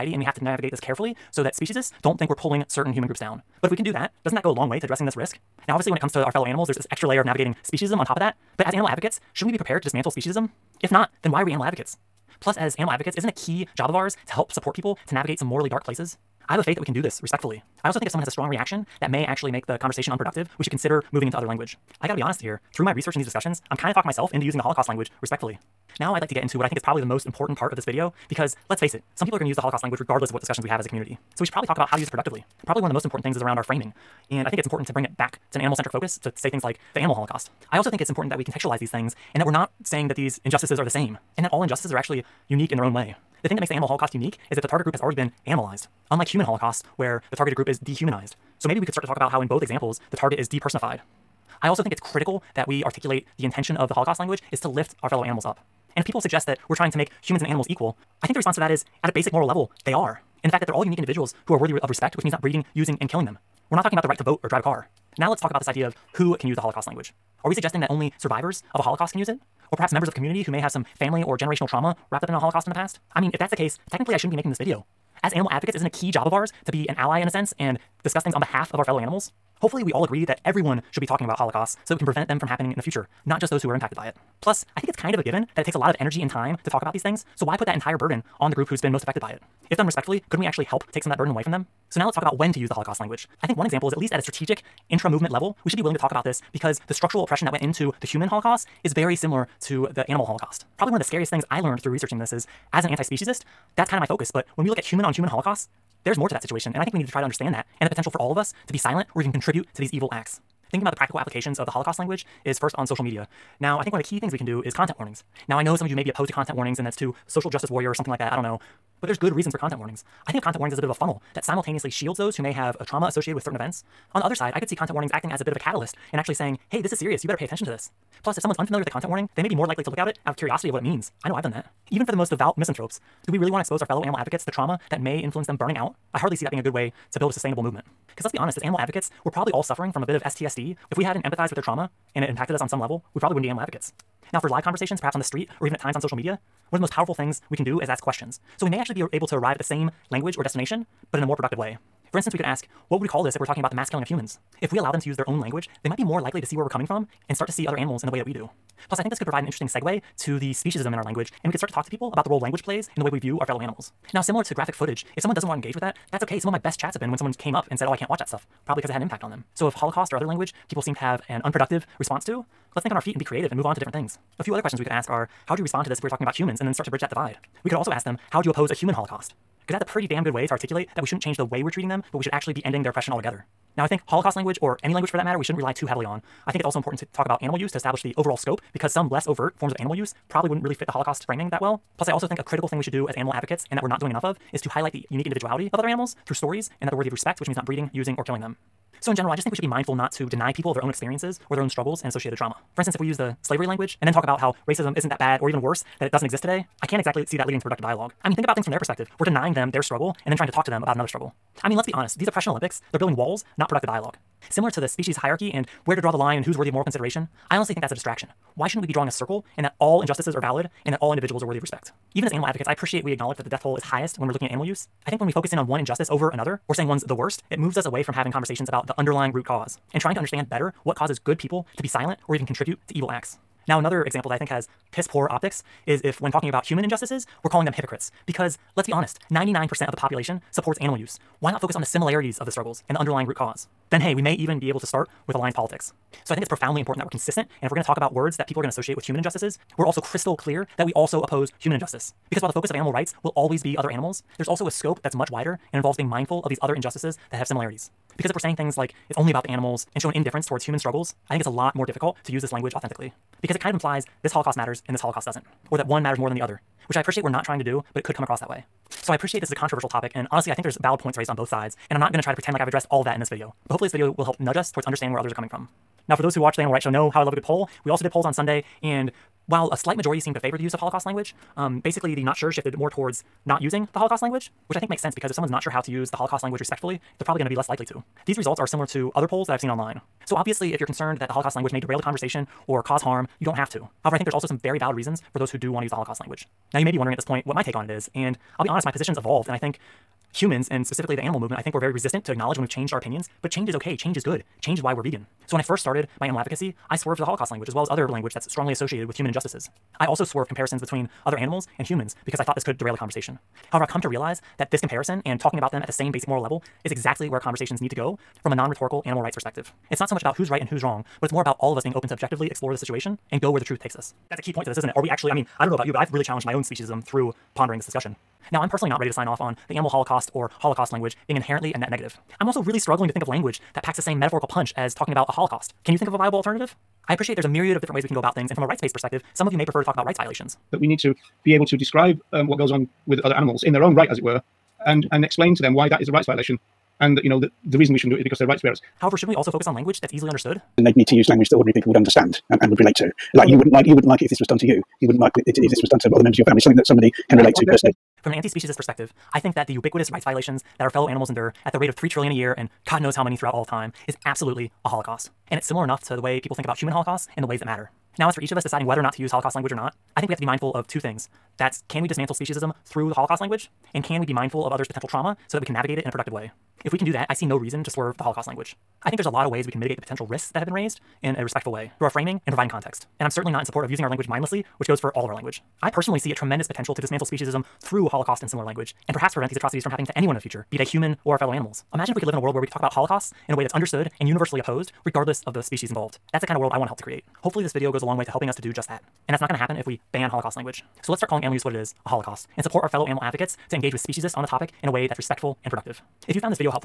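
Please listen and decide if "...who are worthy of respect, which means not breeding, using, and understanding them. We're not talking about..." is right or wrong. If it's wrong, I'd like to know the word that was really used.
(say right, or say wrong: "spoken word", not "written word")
wrong: "killing", not "understanding".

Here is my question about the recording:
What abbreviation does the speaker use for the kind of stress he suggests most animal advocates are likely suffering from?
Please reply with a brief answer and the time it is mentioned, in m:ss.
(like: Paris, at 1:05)
STSD, at 2:20.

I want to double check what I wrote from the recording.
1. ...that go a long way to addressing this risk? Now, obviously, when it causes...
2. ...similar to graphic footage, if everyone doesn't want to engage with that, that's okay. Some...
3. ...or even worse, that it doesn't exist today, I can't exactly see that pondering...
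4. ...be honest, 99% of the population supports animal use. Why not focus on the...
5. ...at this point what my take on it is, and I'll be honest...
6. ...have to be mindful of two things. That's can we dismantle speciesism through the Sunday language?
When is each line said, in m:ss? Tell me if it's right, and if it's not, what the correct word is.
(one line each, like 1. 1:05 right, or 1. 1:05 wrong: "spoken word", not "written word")
1. 0:04 wrong: "comes", not "causes"
2. 2:44 wrong: "someone", not "everyone"
3. 3:25 wrong: "leading", not "pondering"
4. 3:58 right
5. 4:57 right
6. 6:10 wrong: "Holocaust", not "Sunday".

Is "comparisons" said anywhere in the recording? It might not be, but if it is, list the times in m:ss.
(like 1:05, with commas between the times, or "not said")
5:10, 5:14.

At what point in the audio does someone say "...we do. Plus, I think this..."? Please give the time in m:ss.
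2:38.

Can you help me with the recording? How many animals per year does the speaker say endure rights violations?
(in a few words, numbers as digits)
3 trillion.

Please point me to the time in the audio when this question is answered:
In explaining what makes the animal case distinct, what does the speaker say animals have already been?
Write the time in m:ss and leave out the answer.
0:45.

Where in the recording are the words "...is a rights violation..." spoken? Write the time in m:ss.
5:46.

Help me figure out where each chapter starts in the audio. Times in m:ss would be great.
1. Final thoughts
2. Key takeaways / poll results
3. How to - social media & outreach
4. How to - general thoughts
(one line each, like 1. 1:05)
1. 5:57
2. 4:28
3. 1:50
4. 0:25.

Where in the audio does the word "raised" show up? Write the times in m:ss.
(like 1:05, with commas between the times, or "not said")
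4:31, 6:20.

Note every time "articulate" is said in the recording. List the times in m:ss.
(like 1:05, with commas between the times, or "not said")
0:52, 3:00.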